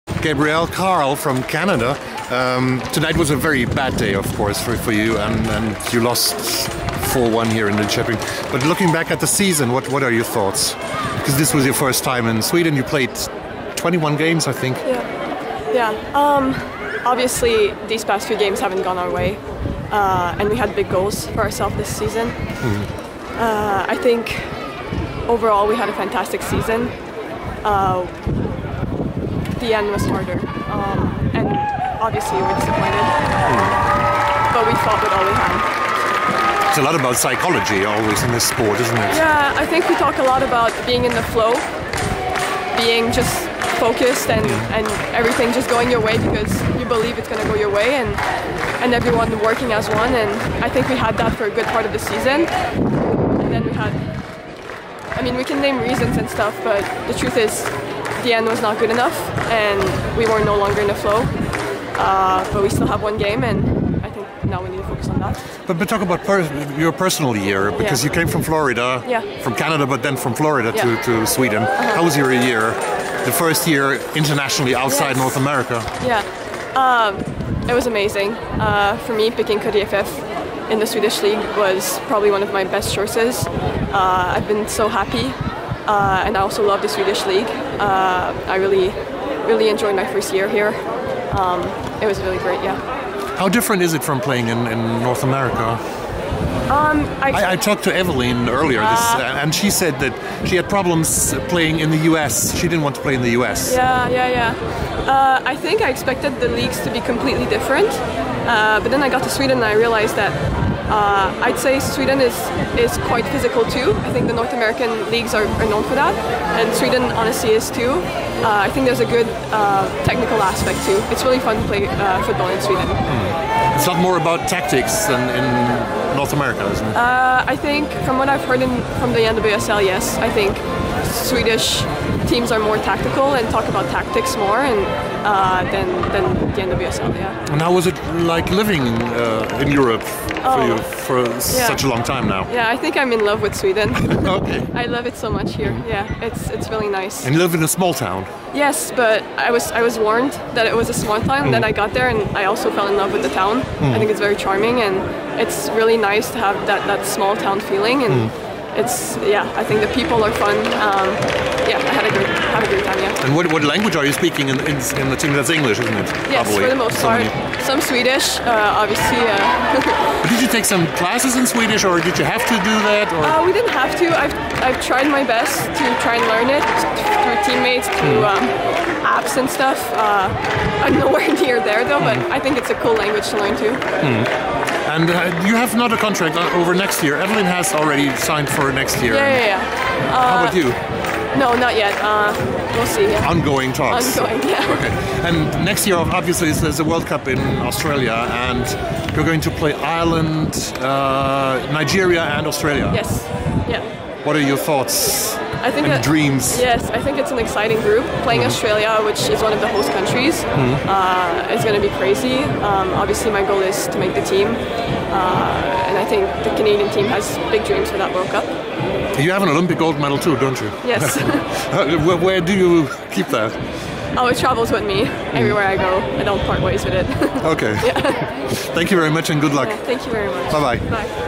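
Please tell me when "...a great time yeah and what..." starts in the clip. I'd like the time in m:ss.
2:42.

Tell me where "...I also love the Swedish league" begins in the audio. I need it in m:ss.
1:26.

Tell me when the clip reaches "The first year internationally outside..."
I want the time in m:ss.
1:13.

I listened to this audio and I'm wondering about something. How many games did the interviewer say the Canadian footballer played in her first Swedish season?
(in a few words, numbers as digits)
21.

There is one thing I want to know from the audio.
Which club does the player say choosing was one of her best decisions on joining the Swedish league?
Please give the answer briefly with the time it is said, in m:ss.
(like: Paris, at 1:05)
KDFF, at 1:19.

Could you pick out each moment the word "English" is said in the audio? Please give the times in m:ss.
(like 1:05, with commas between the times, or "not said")
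2:45.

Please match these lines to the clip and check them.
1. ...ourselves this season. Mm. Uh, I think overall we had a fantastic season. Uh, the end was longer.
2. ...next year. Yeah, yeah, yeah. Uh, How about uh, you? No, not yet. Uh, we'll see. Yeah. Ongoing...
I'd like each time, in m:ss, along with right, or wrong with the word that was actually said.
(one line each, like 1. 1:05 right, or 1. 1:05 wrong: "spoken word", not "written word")
1. 0:21 wrong: "harder", not "longer"
2. 3:08 right.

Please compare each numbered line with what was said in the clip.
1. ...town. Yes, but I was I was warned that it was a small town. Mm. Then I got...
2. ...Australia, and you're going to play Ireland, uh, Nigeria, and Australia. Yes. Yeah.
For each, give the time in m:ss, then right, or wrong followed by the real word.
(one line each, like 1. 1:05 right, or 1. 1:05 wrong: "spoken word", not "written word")
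1. 2:27 right
2. 3:17 right.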